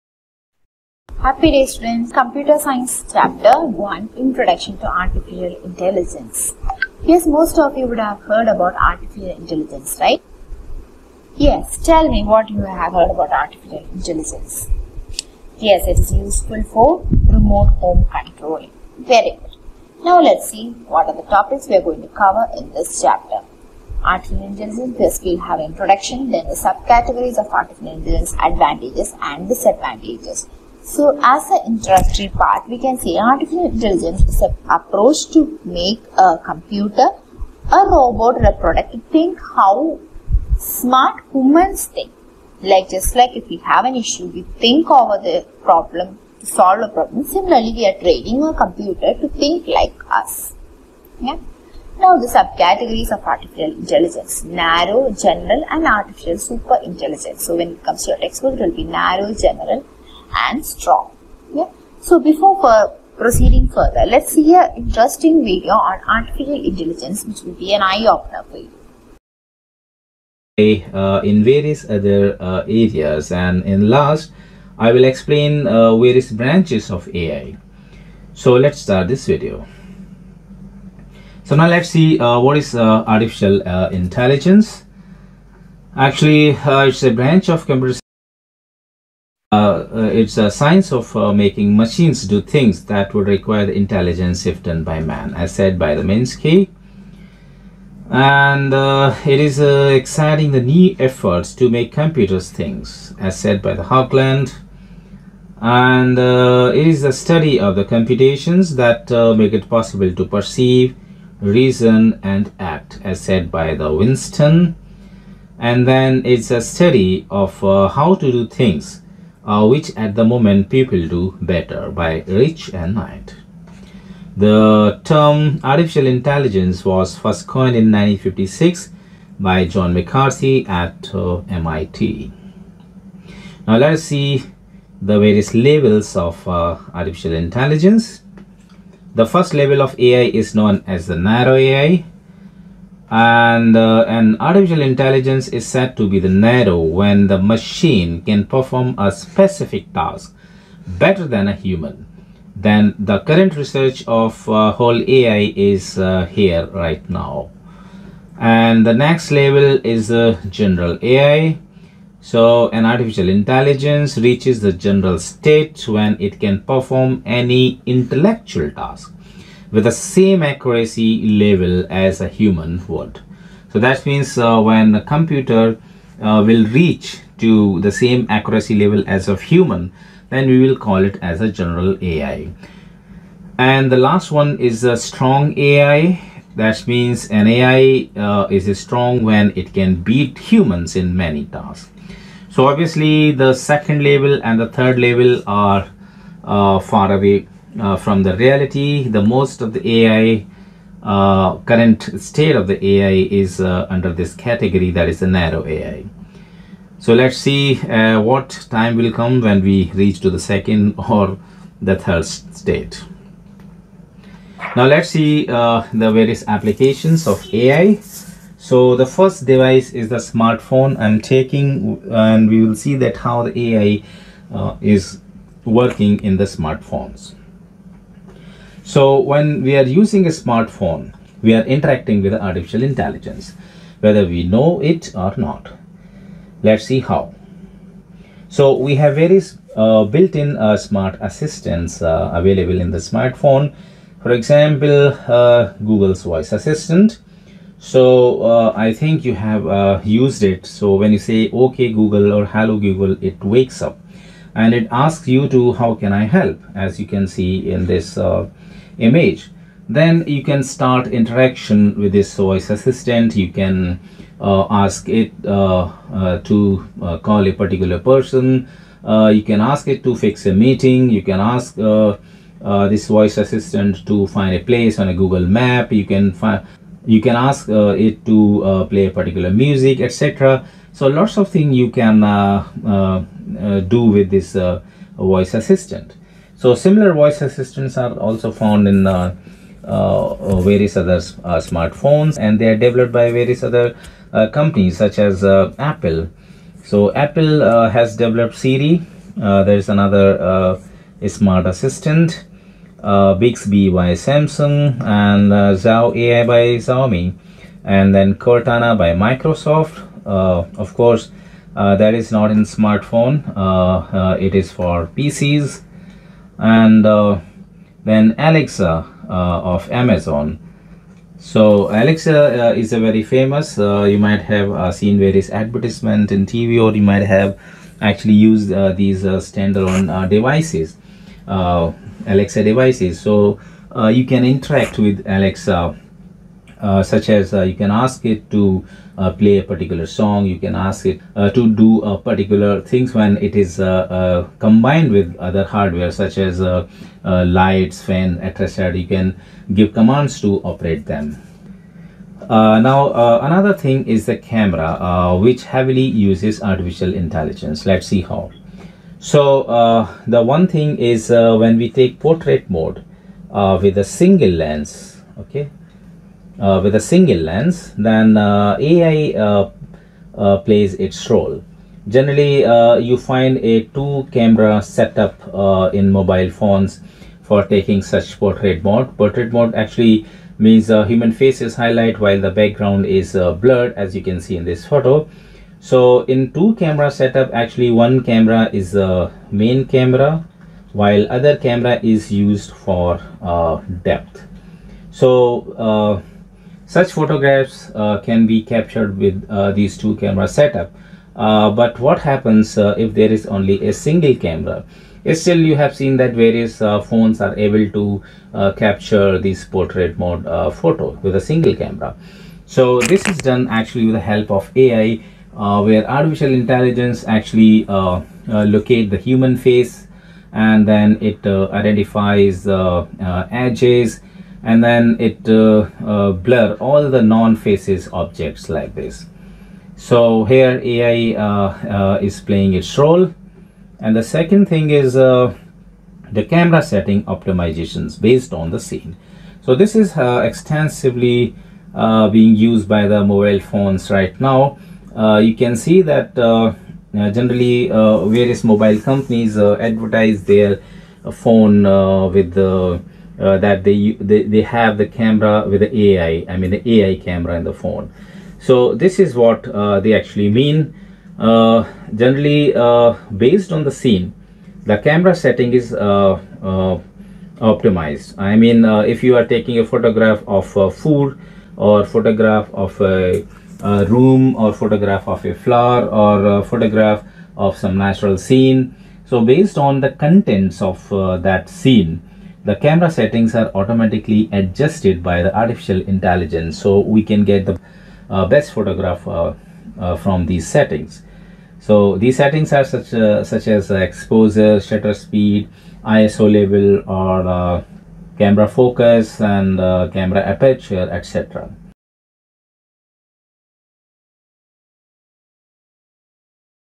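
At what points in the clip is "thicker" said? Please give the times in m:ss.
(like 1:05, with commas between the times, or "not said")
not said.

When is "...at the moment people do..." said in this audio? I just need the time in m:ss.
1:59.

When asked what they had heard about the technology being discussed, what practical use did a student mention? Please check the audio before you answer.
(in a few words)
Remote home control.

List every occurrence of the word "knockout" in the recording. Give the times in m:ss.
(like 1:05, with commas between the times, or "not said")
not said.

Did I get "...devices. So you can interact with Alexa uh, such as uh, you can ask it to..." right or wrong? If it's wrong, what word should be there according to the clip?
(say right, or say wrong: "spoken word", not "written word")
right.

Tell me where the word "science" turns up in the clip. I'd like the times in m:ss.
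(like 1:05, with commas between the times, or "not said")
0:02, 1:30.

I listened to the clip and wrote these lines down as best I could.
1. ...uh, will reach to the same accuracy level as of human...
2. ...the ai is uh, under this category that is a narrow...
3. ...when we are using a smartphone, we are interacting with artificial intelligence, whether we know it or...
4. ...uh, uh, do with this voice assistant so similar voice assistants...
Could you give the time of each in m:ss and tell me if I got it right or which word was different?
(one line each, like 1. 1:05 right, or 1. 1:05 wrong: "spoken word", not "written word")
1. 2:56 right
2. 3:22 right
3. 3:49 right
4. 4:42 right.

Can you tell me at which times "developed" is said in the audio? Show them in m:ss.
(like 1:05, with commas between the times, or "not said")
4:52, 4:58.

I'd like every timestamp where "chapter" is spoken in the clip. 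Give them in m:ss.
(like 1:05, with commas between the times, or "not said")
0:03, 0:22.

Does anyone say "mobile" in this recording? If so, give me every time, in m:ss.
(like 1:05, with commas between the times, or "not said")
6:16, 7:23, 7:28.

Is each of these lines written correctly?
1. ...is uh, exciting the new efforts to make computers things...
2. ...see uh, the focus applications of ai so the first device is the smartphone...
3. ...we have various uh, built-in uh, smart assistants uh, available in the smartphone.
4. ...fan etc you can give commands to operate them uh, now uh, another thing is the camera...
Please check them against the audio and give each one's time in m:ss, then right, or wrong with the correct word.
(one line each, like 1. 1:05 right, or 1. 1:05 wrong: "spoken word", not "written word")
1. 1:39 right
2. 3:35 wrong: "various", not "focus"
3. 3:58 right
4. 5:48 right.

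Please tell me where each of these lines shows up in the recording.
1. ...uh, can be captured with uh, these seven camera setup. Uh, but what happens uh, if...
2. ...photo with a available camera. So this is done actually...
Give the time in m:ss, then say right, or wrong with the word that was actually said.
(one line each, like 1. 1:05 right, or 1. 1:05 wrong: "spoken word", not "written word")
1. 6:37 wrong: "two", not "seven"
2. 6:50 wrong: "single", not "available".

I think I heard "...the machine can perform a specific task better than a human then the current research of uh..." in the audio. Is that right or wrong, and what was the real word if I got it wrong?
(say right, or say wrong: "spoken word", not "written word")
right.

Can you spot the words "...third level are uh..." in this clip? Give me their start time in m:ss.
3:14.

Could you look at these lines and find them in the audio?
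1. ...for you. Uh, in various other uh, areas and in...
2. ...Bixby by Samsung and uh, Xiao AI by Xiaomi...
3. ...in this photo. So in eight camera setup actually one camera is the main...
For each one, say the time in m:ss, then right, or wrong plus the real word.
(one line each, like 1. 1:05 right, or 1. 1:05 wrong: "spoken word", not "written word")
1. 1:08 right
2. 5:03 right
3. 6:24 wrong: "two", not "eight".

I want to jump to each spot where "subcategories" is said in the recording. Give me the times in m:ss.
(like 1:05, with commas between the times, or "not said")
0:26, 0:52.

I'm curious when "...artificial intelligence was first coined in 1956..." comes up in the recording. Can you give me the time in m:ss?
2:05.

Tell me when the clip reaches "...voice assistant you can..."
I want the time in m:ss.
4:22.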